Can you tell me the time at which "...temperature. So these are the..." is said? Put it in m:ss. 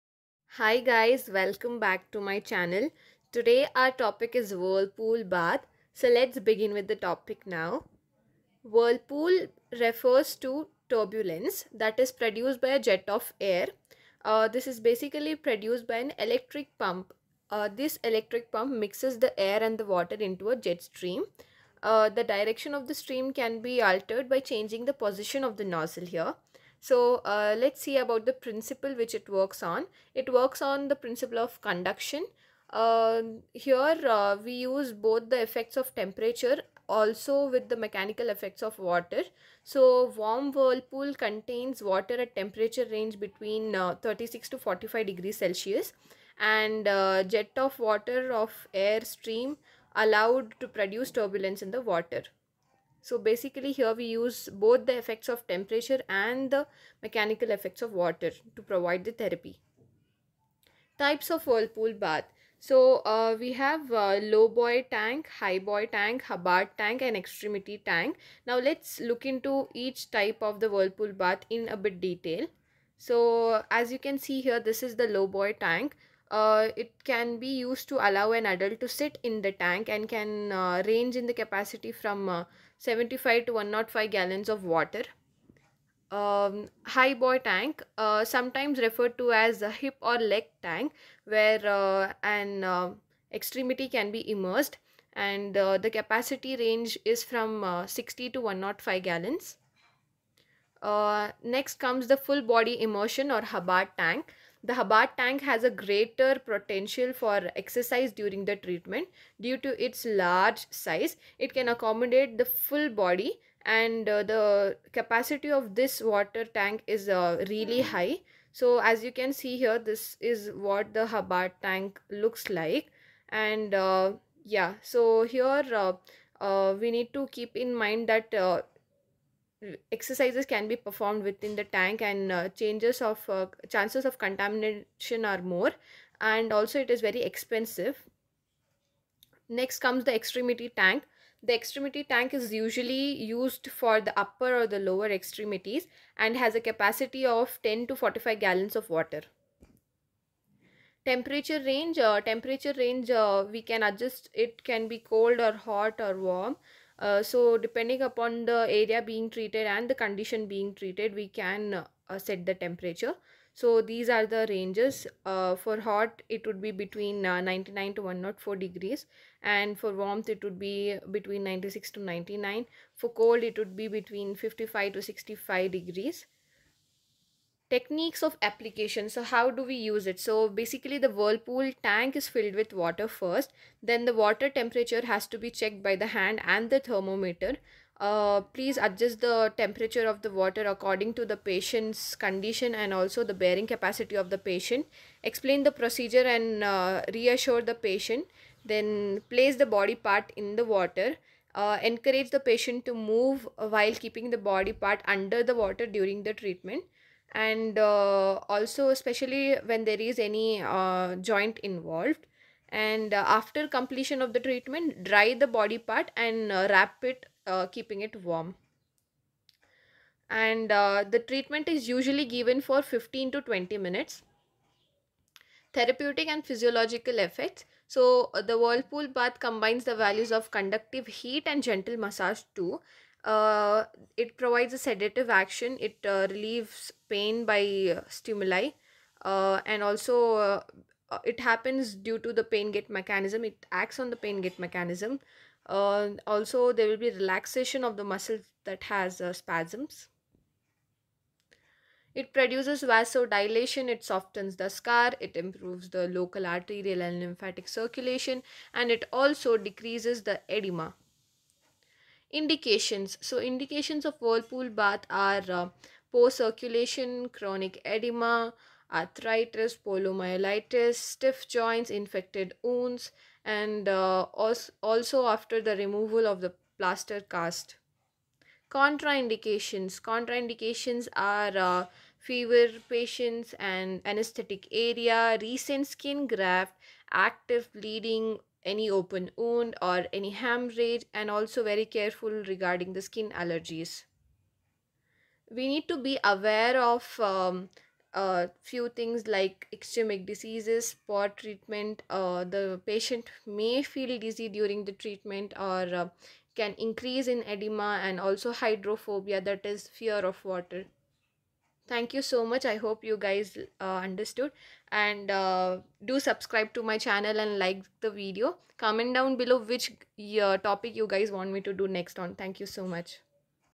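2:42.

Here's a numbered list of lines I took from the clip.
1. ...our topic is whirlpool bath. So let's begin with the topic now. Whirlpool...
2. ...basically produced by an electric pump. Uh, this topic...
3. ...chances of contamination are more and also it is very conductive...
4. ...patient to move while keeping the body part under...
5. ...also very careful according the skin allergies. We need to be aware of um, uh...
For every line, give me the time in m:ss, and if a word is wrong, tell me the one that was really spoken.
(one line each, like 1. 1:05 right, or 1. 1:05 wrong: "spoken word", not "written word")
1. 0:03 right
2. 0:14 wrong: "electric", not "topic"
3. 2:13 wrong: "expensive", not "conductive"
4. 3:22 right
5. 4:51 wrong: "regarding", not "according".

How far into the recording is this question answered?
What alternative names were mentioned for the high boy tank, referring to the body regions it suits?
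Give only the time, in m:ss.
1:29.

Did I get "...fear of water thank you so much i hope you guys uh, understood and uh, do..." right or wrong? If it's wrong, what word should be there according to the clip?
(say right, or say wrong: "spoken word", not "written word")
right.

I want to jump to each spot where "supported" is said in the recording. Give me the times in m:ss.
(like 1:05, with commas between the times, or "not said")
not said.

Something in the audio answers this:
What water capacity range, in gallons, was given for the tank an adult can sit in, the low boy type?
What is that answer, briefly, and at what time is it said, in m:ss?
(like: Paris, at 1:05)
75 to 105 gallons, at 1:22.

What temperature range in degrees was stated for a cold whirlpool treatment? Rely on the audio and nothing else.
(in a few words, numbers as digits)
55 to 65 degrees.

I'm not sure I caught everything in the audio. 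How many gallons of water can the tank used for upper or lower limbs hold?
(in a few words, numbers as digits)
10 to 45 gallons.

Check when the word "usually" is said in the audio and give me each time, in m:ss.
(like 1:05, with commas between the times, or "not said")
2:22, 3:41.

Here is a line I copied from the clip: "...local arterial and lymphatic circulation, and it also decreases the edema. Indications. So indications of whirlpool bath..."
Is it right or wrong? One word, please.
right.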